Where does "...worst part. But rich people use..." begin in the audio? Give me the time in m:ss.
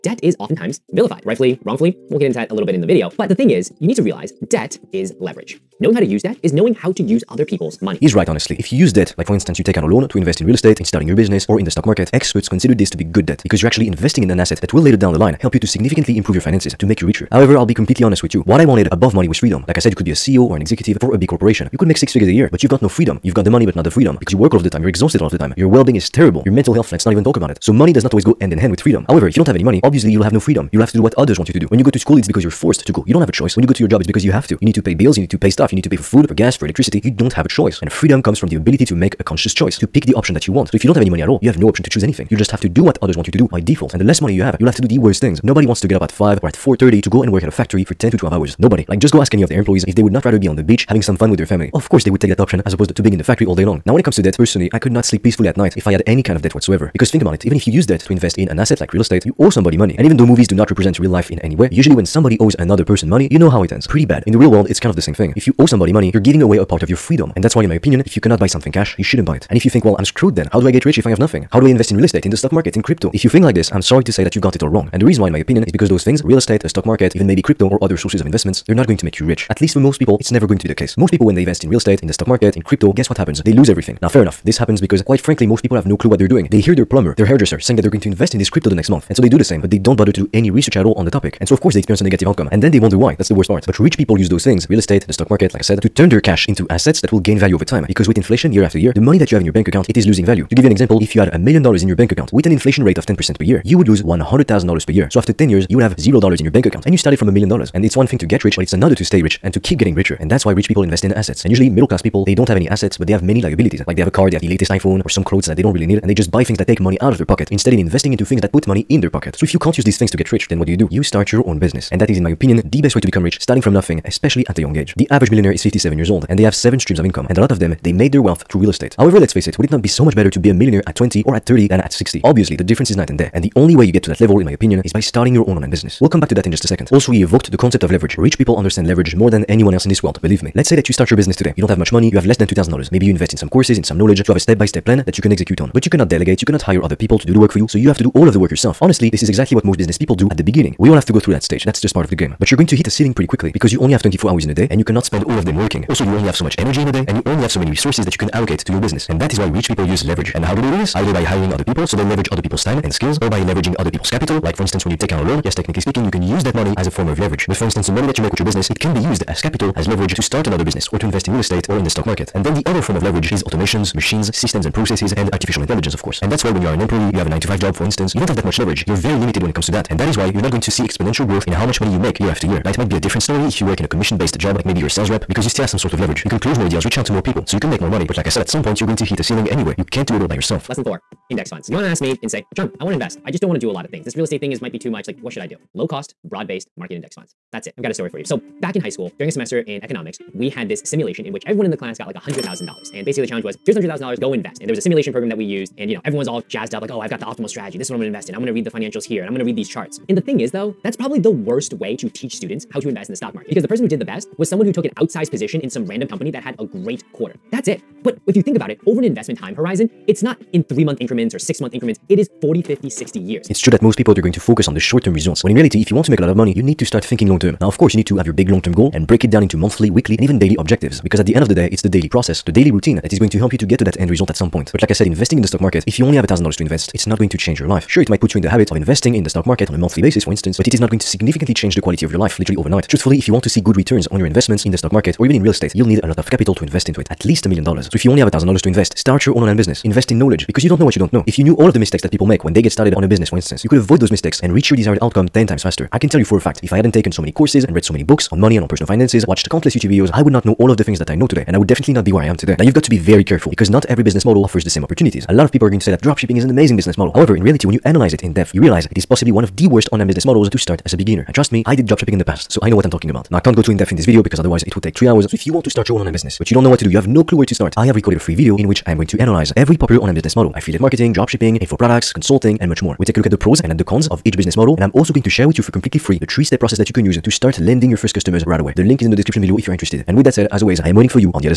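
1:33.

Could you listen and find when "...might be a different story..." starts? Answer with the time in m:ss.
3:02.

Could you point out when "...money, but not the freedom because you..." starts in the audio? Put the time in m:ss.
0:23.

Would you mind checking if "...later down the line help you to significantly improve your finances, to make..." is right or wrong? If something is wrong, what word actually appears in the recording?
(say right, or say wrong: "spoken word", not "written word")
right.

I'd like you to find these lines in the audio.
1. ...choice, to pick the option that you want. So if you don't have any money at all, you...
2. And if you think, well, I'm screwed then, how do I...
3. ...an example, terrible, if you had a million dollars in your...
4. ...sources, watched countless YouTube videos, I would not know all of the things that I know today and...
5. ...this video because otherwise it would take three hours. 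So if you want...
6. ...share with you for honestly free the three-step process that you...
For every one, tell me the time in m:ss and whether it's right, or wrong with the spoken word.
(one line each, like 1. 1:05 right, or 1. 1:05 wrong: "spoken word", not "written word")
1. 0:39 right
2. 1:09 right
3. 1:40 wrong: "example", not "terrible"
4. 4:18 wrong: "finances", not "sources"
5. 4:33 right
6. 4:45 wrong: "completely", not "honestly".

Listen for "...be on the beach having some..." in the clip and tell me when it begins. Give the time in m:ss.
0:50.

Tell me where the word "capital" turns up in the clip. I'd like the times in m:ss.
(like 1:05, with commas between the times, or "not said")
2:44, 2:49, 4:06.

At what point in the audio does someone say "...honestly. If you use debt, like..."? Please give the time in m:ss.
0:08.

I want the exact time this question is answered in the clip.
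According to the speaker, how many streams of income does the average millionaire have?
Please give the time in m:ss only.
2:06.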